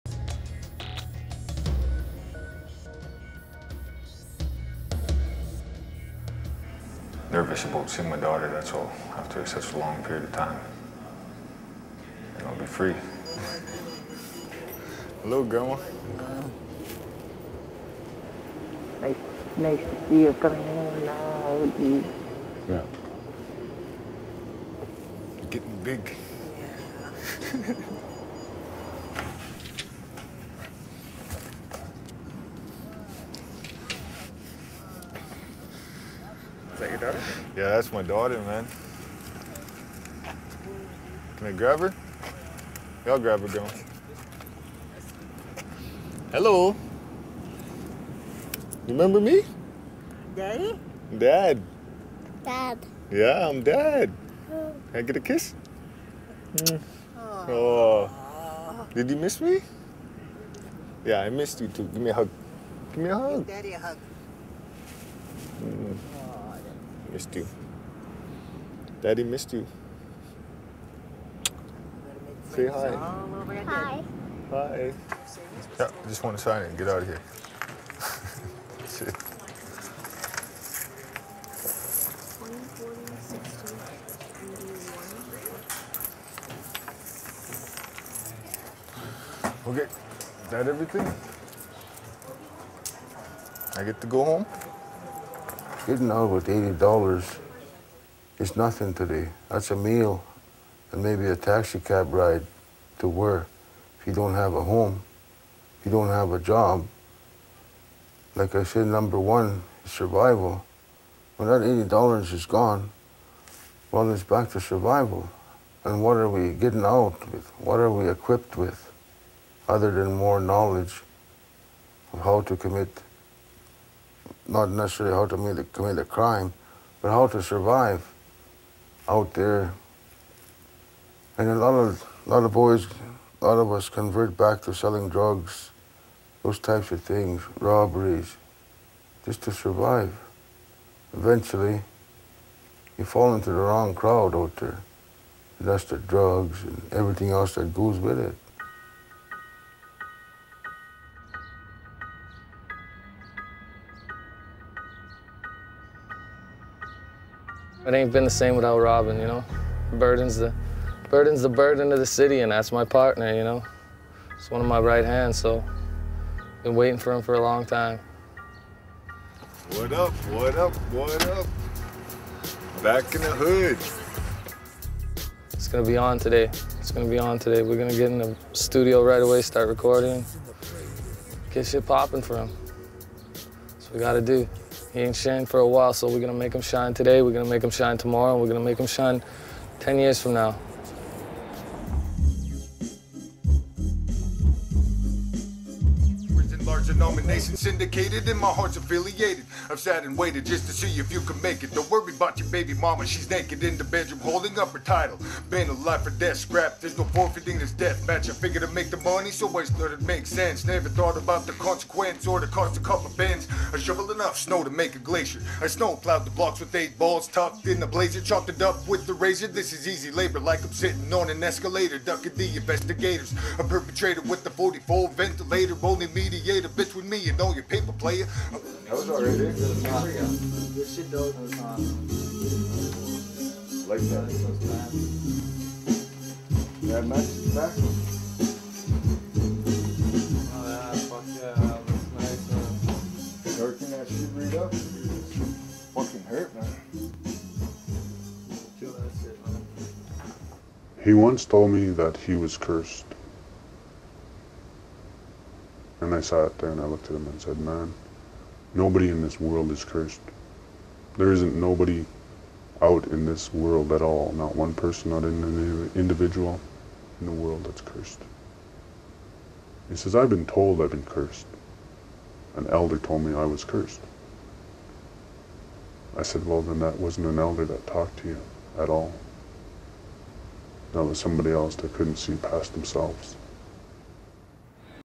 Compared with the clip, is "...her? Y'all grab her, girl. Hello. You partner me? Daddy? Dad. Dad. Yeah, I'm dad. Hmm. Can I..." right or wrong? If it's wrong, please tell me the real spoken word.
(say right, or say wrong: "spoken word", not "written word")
wrong: "remember", not "partner".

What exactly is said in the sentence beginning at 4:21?
There isn't nobody out in this world at all, not one person, not an individual in the world that's cursed.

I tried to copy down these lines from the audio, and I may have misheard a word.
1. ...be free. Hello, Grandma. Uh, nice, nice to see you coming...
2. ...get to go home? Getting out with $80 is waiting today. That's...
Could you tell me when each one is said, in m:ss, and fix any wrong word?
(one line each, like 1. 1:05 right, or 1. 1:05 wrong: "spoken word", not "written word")
1. 0:12 right
2. 1:33 wrong: "nothing", not "waiting".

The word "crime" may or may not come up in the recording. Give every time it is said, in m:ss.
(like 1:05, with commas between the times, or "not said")
2:06.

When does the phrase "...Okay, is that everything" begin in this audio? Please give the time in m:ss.
1:29.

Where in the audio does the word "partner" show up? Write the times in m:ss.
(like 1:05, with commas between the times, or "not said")
2:42.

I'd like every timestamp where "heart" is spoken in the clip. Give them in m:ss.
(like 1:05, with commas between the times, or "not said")
3:18.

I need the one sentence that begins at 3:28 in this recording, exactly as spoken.
I figured to make the money, so I started make sense.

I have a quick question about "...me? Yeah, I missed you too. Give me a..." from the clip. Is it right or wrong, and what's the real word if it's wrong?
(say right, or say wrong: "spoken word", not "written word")
right.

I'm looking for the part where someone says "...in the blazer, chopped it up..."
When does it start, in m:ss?
3:37.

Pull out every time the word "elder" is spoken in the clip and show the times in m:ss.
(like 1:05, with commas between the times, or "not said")
4:32, 4:37.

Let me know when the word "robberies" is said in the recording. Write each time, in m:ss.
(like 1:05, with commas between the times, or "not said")
2:17.